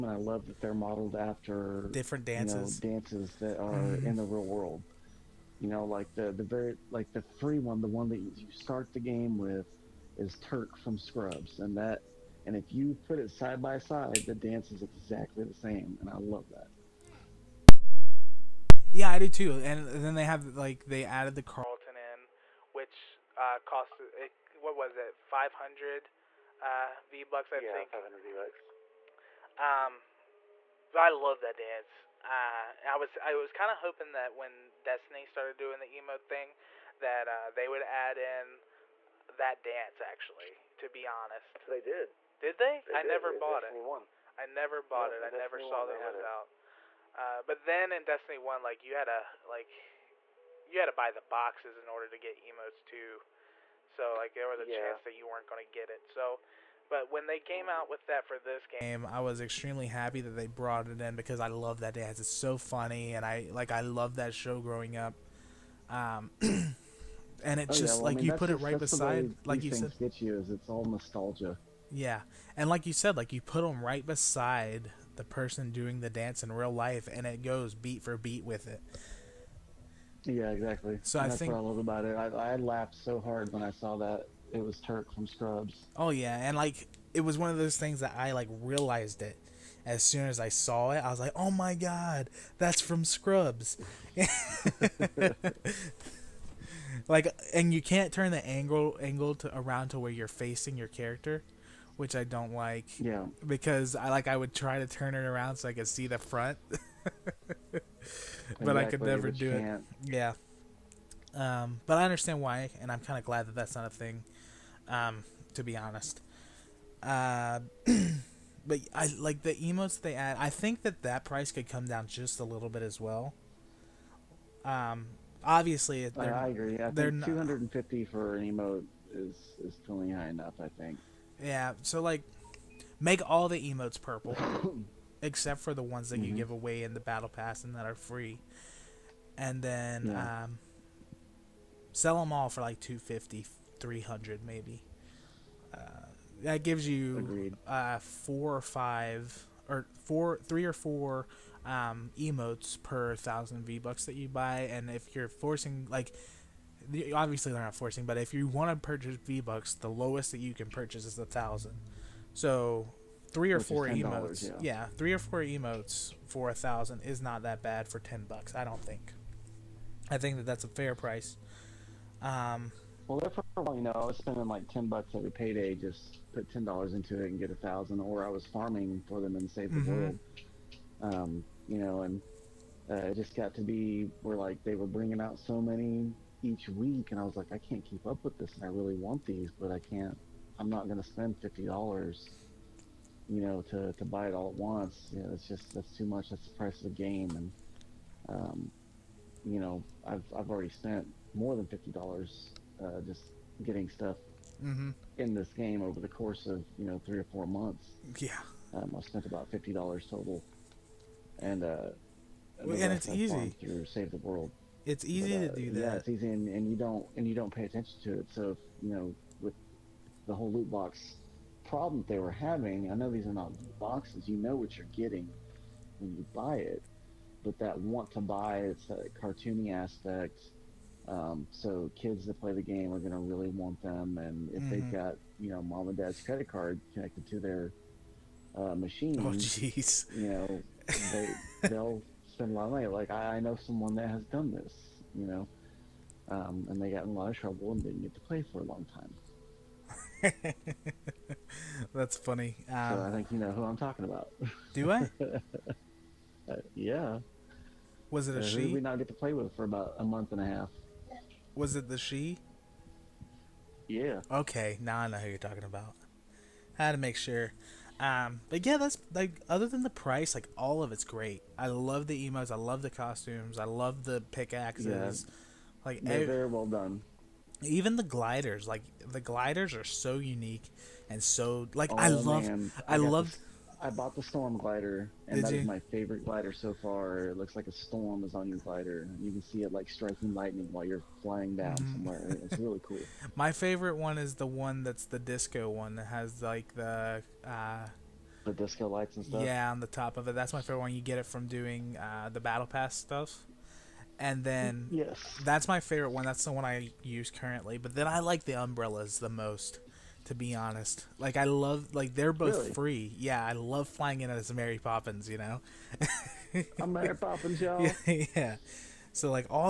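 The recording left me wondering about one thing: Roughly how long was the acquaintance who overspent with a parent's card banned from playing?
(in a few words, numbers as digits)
a month and a half.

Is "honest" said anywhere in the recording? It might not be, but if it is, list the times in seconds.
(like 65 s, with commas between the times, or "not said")
41 s, 115 s, 310 s.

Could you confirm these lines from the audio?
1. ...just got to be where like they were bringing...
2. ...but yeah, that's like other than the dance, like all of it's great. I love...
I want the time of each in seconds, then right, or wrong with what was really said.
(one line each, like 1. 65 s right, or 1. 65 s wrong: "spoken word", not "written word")
1. 183 s right
2. 268 s wrong: "price", not "dance".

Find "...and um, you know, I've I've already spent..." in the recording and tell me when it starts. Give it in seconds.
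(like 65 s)
197 s.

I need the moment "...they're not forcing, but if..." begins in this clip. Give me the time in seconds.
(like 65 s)
157 s.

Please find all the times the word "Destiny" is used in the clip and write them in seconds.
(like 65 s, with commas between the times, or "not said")
34 s, 48 s.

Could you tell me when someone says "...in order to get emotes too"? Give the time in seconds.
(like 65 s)
51 s.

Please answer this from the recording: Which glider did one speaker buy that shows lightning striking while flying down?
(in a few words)
storm glider.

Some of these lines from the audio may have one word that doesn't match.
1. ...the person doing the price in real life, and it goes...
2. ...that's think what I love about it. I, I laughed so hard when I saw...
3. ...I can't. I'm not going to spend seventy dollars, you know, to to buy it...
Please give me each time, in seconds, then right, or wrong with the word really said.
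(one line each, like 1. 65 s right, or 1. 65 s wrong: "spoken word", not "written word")
1. 75 s wrong: "dance", not "price"
2. 81 s right
3. 189 s wrong: "fifty", not "seventy".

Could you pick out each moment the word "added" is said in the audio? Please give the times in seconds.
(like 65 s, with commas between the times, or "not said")
21 s.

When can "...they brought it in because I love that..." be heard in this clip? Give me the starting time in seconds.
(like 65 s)
60 s.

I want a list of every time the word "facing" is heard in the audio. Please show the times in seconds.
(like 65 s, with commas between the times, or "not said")
100 s.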